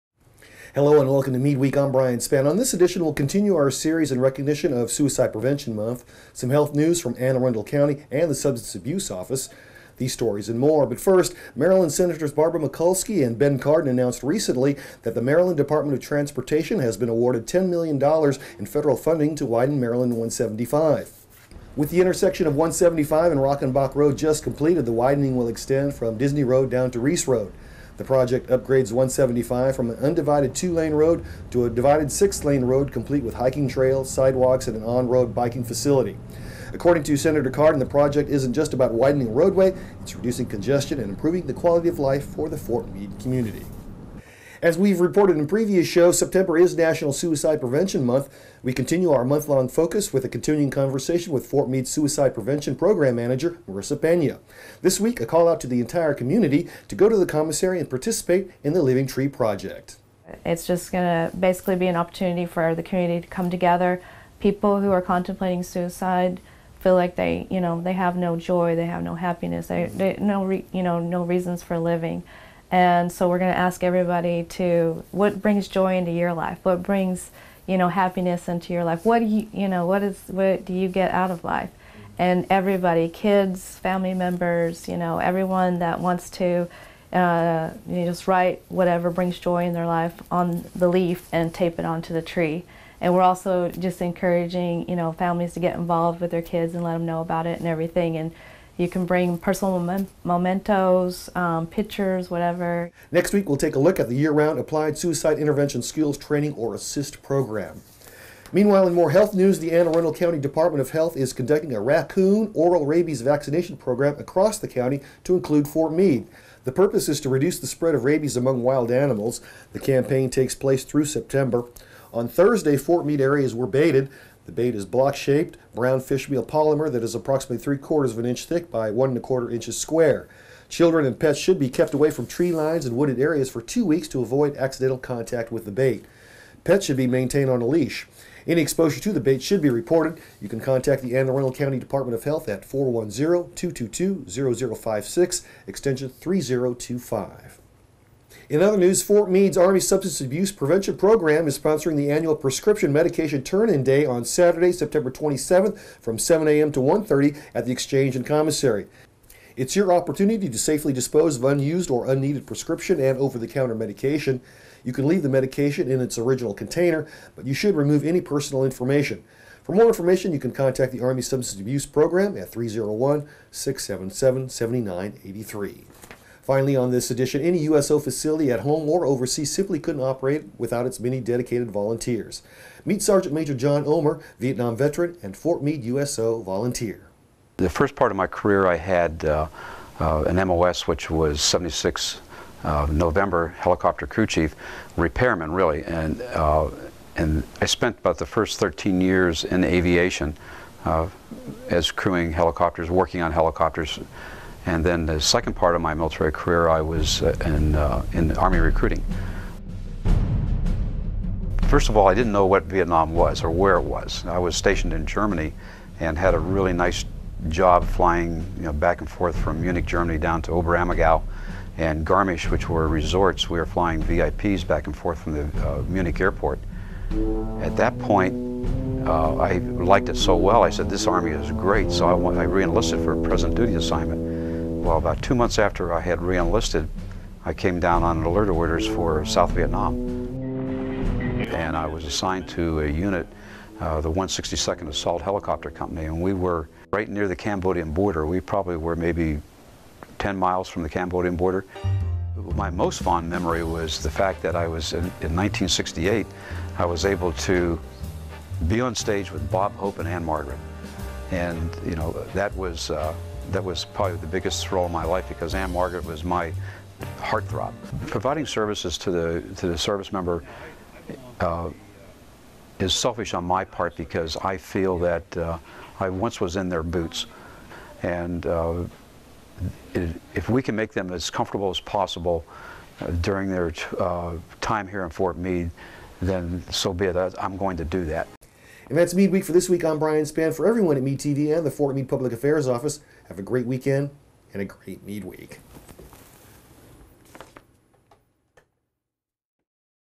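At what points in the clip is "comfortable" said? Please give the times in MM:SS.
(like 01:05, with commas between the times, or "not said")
04:41.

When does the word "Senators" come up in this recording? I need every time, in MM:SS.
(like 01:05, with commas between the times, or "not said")
00:11, 00:37.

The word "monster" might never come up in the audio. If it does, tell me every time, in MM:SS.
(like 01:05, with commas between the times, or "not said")
not said.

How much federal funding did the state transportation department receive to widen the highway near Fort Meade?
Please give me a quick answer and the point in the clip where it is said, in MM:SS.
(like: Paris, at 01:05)
$10 million, at 00:17.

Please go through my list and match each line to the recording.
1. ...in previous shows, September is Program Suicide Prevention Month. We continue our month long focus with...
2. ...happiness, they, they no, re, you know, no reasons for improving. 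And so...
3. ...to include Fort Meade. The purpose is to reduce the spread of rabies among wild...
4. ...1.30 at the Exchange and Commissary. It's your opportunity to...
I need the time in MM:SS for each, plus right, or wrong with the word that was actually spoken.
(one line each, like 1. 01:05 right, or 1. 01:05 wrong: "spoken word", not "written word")
1. 00:45 wrong: "National", not "Program"
2. 01:09 wrong: "living", not "improving"
3. 01:55 right
4. 02:36 right.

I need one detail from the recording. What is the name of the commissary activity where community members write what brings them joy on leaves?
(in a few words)
Living Tree Project.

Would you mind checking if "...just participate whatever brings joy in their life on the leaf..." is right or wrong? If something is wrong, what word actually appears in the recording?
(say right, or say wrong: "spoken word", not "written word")
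wrong: "write", not "participate".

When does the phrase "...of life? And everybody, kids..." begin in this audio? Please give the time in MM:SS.
01:21.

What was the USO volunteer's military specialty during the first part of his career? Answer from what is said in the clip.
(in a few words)
helicopter crew chief.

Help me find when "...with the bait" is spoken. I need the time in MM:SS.
02:15.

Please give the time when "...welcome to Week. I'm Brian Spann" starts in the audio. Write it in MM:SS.
00:01.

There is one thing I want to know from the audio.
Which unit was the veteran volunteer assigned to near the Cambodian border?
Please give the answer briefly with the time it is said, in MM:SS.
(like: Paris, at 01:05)
162nd Assault Helicopter Company, at 04:04.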